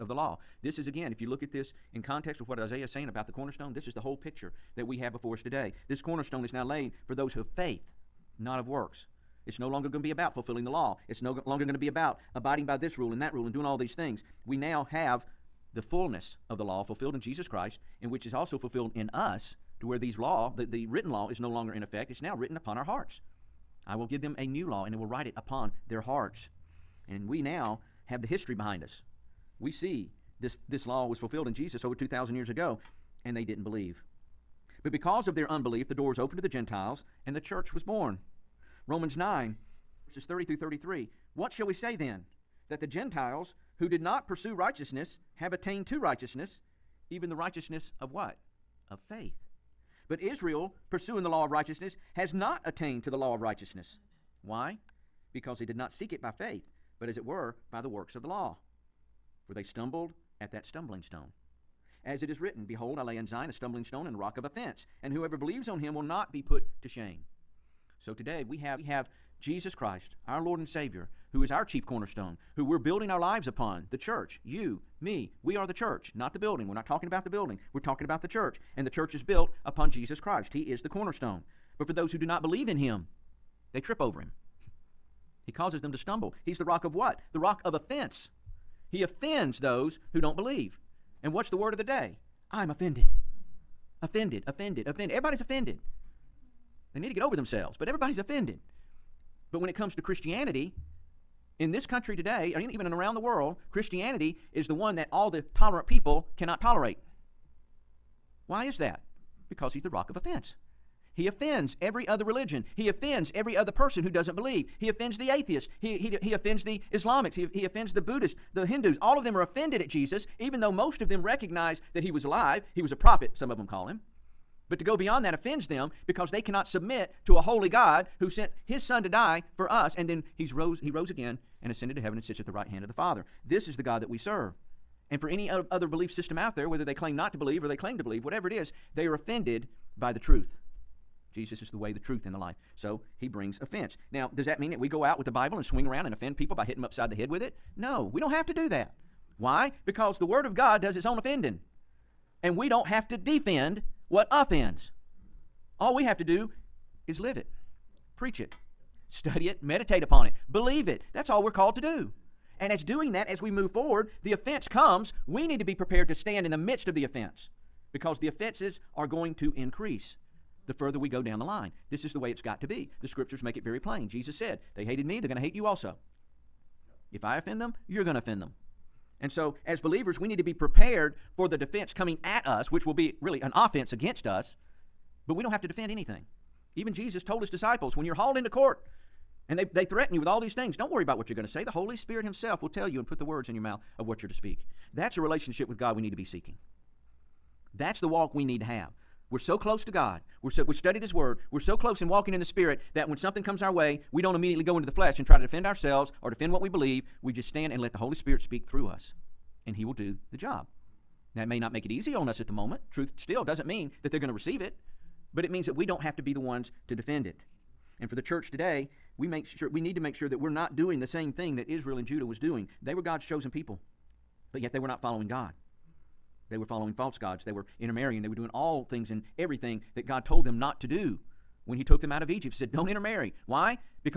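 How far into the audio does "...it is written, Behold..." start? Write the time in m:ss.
1:02.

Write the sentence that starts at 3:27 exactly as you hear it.
We just stand and let the Holy Spirit speak through us and He will do the job.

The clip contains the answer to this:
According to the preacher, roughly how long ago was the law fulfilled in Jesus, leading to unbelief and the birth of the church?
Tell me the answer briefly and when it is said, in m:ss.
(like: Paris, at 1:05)
Over 2,000 years ago, at 0:31.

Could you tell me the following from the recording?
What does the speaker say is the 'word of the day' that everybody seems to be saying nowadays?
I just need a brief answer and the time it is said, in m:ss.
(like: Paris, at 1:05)
I'm offended, at 1:32.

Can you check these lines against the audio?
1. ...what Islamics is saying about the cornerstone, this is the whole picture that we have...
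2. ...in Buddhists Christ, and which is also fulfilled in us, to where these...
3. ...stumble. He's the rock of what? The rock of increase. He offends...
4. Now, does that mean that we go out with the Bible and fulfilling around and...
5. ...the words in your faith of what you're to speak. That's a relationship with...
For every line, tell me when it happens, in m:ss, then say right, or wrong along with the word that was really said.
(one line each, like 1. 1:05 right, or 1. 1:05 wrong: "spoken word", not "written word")
1. 0:02 wrong: "Isaiah", not "Islamics"
2. 0:17 wrong: "Jesus", not "Buddhists"
3. 1:25 wrong: "offense", not "increase"
4. 2:24 wrong: "swing", not "fulfilling"
5. 3:13 wrong: "mouth", not "faith".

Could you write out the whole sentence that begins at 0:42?
That the Gentiles who did not pursue righteousness have attained to righteousness, even the righteousness of what?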